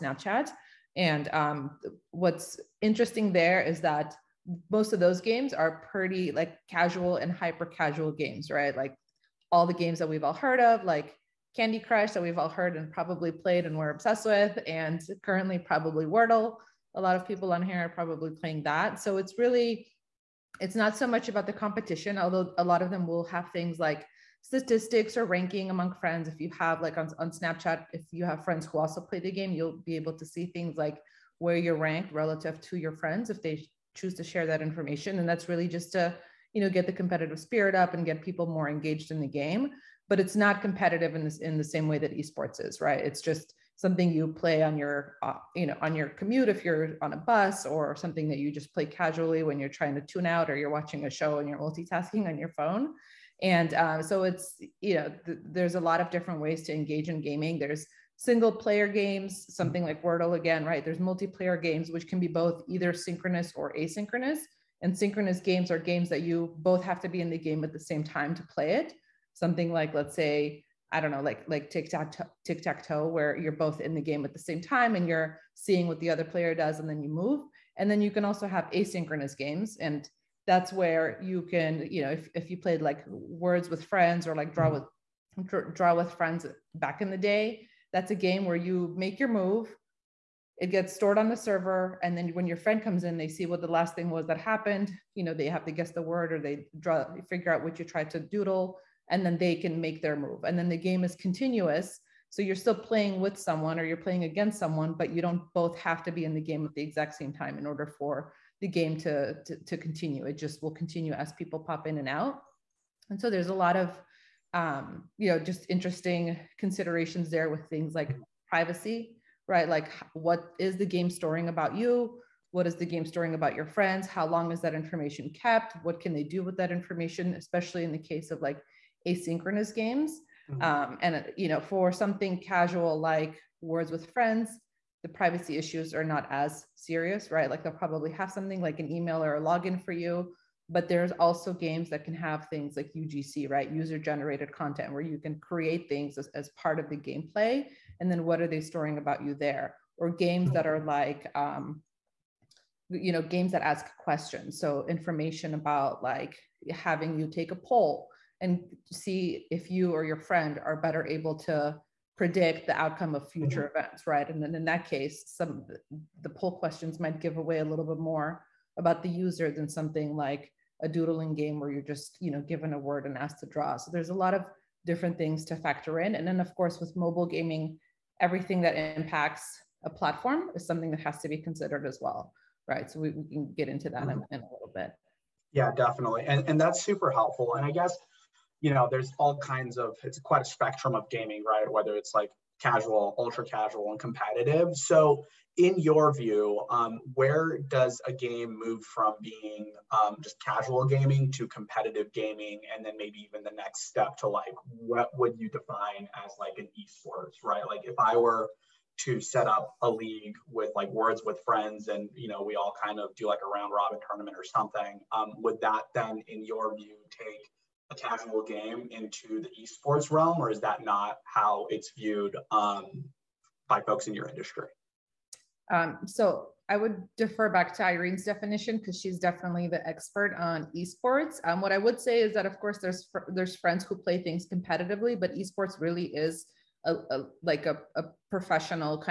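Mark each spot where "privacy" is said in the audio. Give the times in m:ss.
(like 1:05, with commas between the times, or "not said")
1:58, 2:15.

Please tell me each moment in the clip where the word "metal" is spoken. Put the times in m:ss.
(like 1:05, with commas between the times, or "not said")
not said.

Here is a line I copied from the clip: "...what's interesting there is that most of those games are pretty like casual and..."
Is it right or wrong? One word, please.
right.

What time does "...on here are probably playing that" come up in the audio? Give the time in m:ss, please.
0:17.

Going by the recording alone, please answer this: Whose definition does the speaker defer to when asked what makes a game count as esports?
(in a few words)
Irene.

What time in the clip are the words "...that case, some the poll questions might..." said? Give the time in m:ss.
2:44.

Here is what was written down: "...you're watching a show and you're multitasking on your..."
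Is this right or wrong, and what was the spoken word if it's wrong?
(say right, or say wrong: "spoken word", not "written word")
right.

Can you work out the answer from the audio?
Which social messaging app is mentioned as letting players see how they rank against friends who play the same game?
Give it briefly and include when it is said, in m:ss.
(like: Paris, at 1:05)
Snapchat, at 0:27.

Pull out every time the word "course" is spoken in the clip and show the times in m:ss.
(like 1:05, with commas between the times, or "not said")
2:56, 3:52.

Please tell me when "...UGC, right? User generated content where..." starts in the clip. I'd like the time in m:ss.
2:22.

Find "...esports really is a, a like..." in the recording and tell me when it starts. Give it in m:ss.
3:55.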